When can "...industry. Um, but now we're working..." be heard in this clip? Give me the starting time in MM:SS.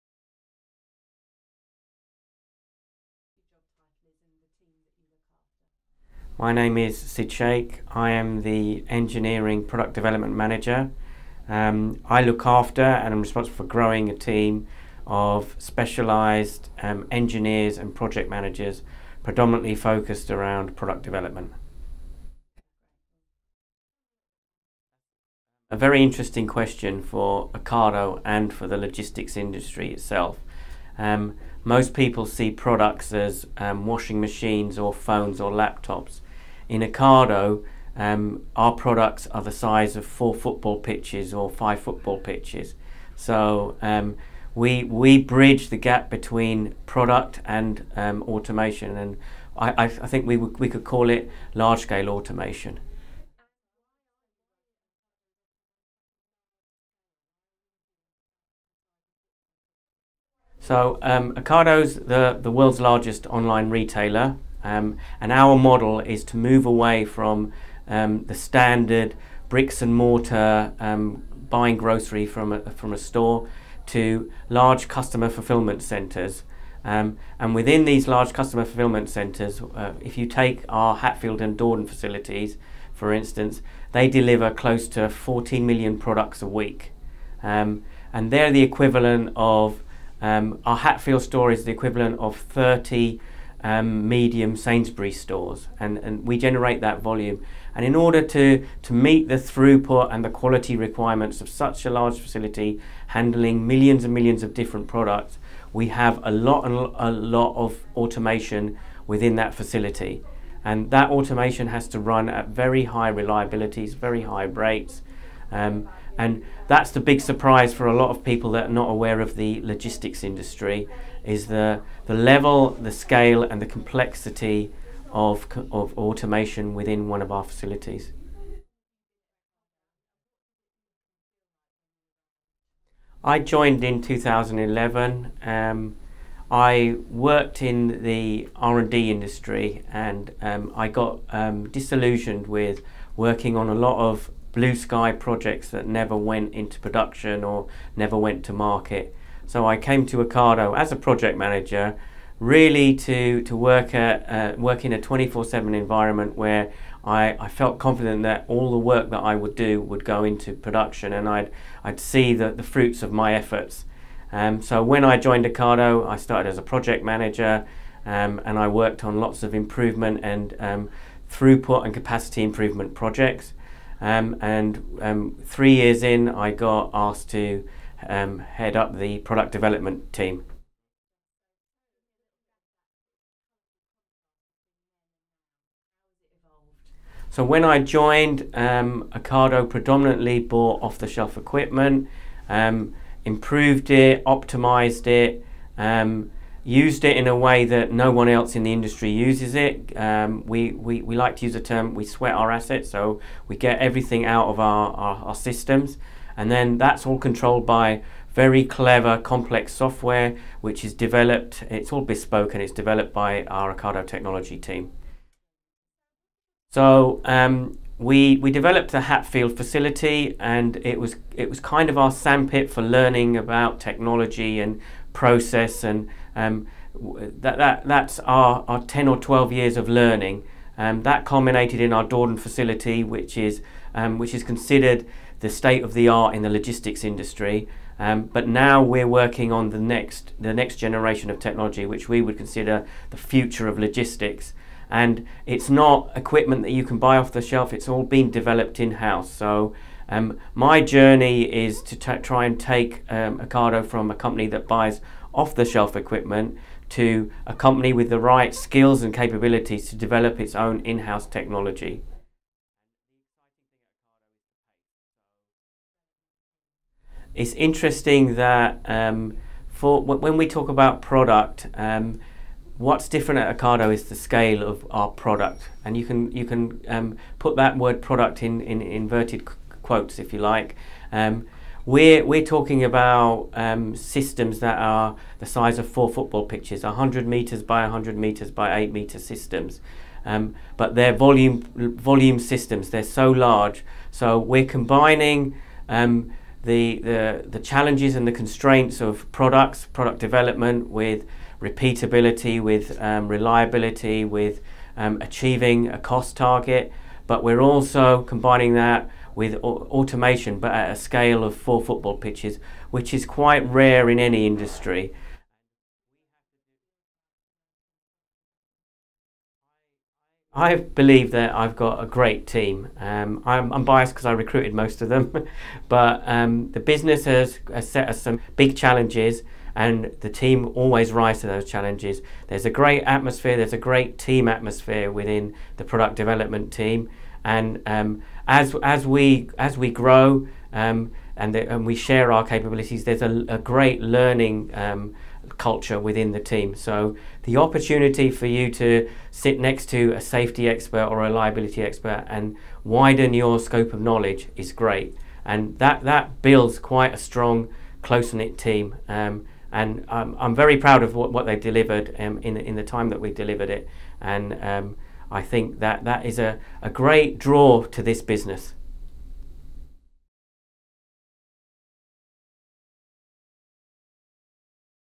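03:57.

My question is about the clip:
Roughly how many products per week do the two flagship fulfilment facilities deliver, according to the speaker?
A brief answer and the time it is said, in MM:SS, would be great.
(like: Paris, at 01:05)
14 million, at 01:25.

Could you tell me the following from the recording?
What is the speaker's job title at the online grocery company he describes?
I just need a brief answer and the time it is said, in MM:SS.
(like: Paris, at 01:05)
Engineering Product Development Manager, at 00:08.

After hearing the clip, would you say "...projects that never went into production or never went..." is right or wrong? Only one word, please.
right.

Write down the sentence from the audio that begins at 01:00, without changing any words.
So um, Ocado's the, the world's largest online retailer.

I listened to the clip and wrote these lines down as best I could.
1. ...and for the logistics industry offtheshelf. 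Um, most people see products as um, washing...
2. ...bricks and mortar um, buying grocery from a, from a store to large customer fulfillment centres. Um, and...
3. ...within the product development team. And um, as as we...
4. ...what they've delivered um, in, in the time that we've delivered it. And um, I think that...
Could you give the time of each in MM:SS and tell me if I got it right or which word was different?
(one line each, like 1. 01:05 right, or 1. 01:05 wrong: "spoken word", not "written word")
1. 00:28 wrong: "itself", not "offtheshelf"
2. 01:09 right
3. 05:35 right
4. 06:01 right.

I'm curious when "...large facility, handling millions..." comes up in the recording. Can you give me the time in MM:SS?
01:41.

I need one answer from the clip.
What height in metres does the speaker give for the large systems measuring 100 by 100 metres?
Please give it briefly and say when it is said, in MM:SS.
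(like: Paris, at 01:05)
8, at 04:48.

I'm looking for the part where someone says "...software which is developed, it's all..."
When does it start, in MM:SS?
03:29.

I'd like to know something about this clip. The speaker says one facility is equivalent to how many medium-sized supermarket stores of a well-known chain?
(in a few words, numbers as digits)
30.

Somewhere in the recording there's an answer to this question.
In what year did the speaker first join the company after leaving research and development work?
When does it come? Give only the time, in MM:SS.
02:14.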